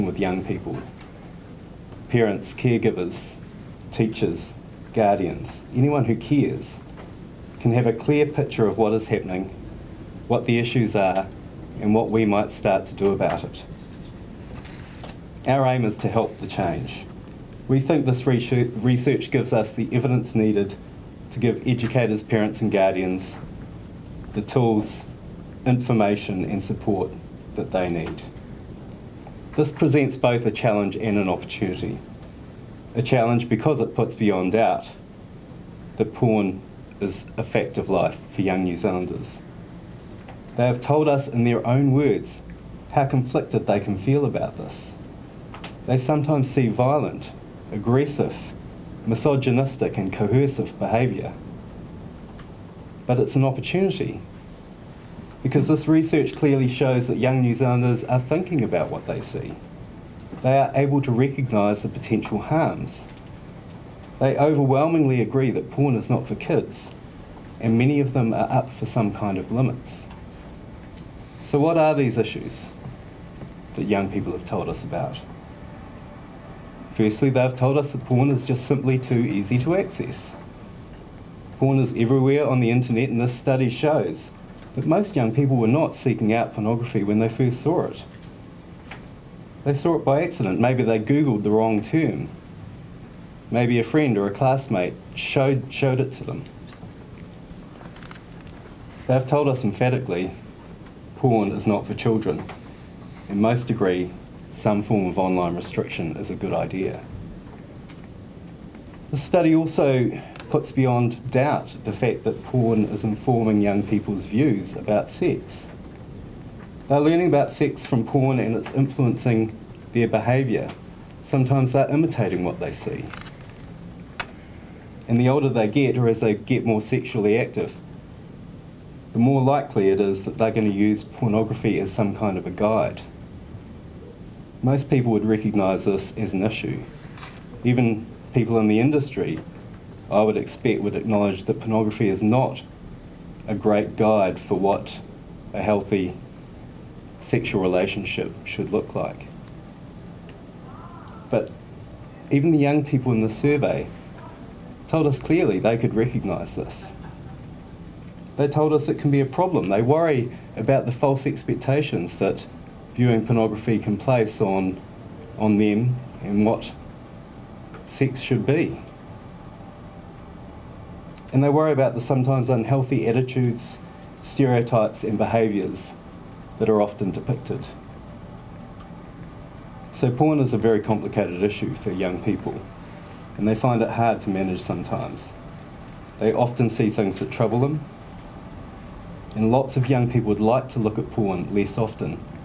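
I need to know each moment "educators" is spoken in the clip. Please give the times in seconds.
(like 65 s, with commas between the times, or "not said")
21 s.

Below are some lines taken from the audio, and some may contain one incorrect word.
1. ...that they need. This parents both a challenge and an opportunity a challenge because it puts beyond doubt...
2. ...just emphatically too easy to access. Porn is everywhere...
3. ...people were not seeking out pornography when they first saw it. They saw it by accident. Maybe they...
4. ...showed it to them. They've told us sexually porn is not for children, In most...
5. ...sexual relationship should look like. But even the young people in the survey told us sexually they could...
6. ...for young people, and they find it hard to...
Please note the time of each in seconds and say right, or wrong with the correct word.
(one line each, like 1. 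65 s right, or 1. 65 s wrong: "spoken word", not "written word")
1. 27 s wrong: "presents", not "parents"
2. 78 s wrong: "simply", not "emphatically"
3. 85 s right
4. 95 s wrong: "emphatically", not "sexually"
5. 147 s wrong: "clearly", not "sexually"
6. 181 s right.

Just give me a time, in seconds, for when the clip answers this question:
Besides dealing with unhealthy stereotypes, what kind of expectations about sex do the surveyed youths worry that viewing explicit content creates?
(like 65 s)
160 s.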